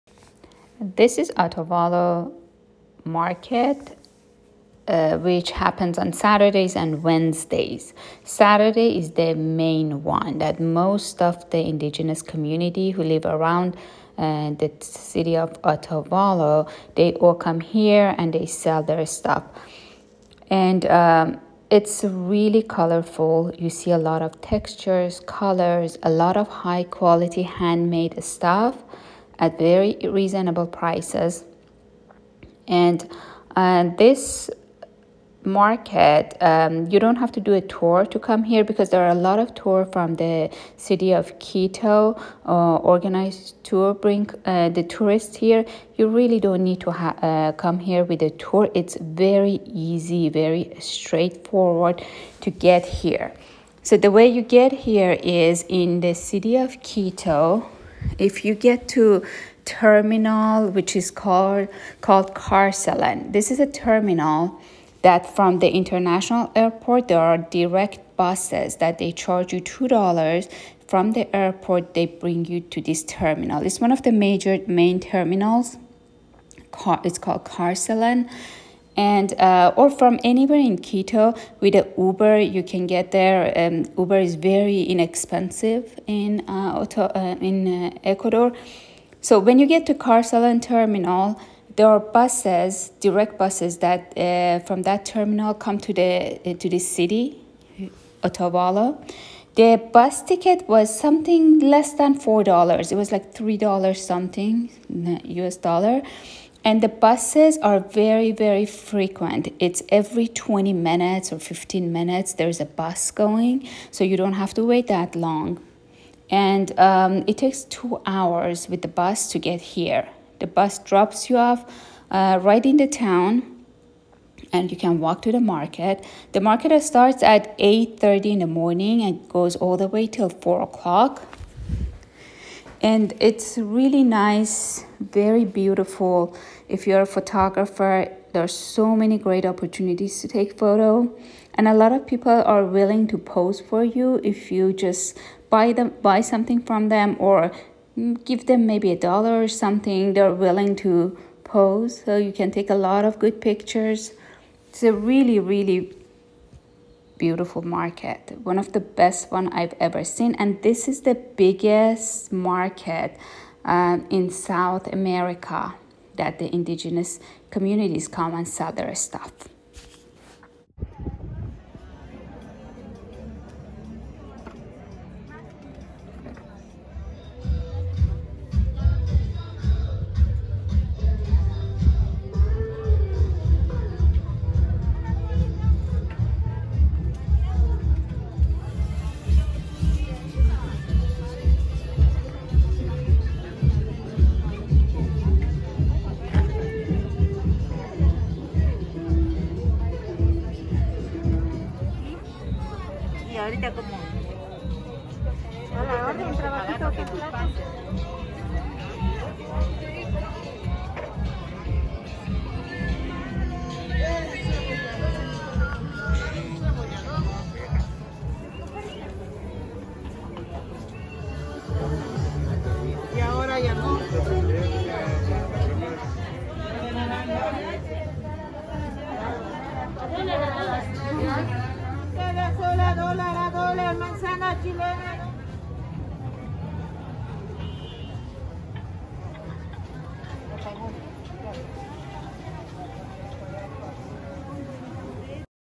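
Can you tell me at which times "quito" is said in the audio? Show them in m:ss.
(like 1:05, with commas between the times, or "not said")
0:41, 0:56, 1:20.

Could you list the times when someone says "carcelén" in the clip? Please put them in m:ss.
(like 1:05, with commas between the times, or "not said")
1:02, 1:17, 1:29.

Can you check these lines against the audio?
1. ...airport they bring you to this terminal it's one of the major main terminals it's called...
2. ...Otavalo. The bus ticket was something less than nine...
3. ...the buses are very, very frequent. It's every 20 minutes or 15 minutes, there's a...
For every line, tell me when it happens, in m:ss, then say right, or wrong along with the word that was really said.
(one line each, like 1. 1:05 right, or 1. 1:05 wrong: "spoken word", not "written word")
1. 1:11 right
2. 1:38 wrong: "four", not "nine"
3. 1:46 right.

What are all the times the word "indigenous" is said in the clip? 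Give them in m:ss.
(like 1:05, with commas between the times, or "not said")
0:11, 2:46.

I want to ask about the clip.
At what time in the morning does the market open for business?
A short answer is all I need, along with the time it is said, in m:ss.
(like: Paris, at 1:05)
8:30, at 2:07.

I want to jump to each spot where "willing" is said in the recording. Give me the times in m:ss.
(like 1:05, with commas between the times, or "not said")
2:22, 2:30.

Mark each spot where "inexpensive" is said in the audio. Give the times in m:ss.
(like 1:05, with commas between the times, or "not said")
1:24.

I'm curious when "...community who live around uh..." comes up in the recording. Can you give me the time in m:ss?
0:12.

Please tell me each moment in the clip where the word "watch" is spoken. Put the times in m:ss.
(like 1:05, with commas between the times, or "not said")
not said.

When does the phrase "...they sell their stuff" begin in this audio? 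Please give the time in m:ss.
0:18.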